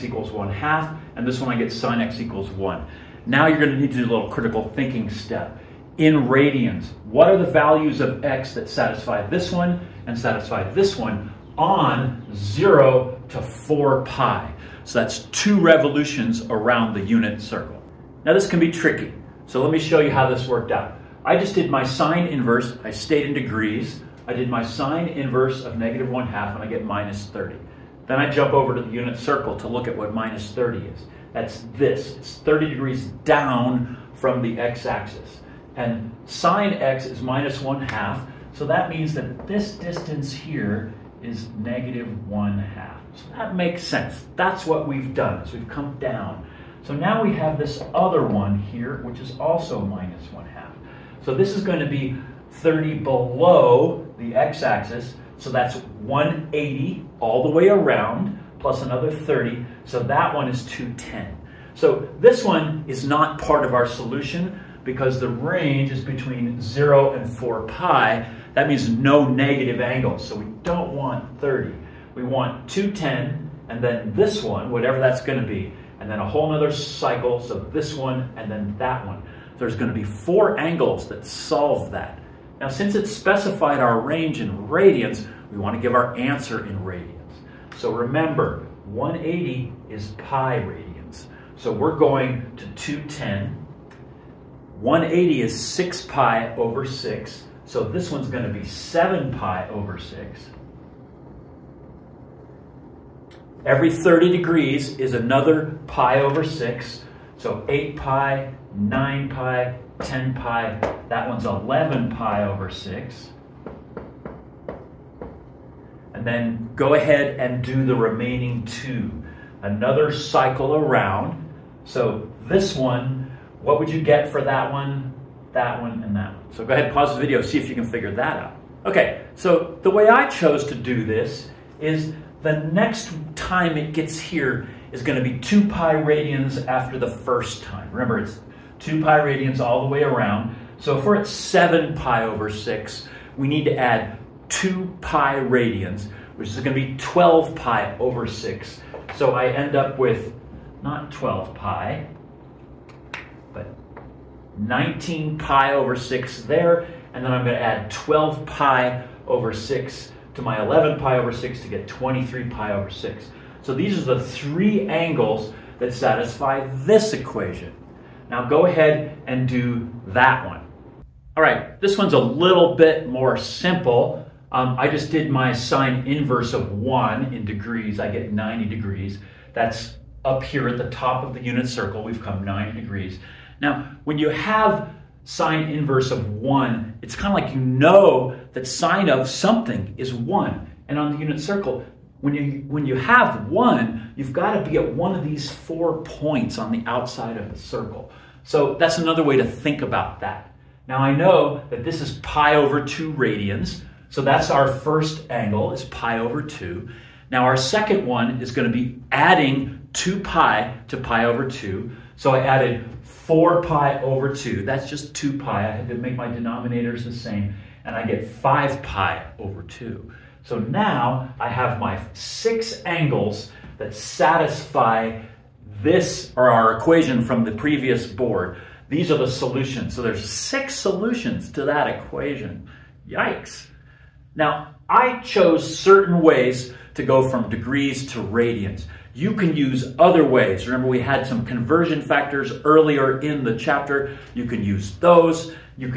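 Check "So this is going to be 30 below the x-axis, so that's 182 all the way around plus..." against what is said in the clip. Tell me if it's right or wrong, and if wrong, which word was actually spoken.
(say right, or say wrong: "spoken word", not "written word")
wrong: "180", not "182".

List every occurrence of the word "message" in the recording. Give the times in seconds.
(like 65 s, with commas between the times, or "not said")
not said.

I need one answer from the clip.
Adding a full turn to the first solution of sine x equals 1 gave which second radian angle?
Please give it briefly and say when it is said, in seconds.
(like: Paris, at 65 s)
5 pi over 2, at 218 s.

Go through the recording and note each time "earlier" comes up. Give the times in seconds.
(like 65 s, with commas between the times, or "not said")
242 s.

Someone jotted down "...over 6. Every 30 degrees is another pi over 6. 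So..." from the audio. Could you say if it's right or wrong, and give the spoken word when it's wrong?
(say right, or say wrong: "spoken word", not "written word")
right.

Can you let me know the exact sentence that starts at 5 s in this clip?
In radians, what are the values of x that satisfy this one and satisfy this one on 0 to 4 pi?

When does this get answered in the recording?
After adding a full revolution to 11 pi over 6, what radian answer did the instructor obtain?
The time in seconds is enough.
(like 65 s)
161 s.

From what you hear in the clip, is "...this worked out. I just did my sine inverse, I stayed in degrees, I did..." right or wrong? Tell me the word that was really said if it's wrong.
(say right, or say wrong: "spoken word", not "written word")
right.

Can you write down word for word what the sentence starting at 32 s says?
It's 30 degrees down from the x-axis.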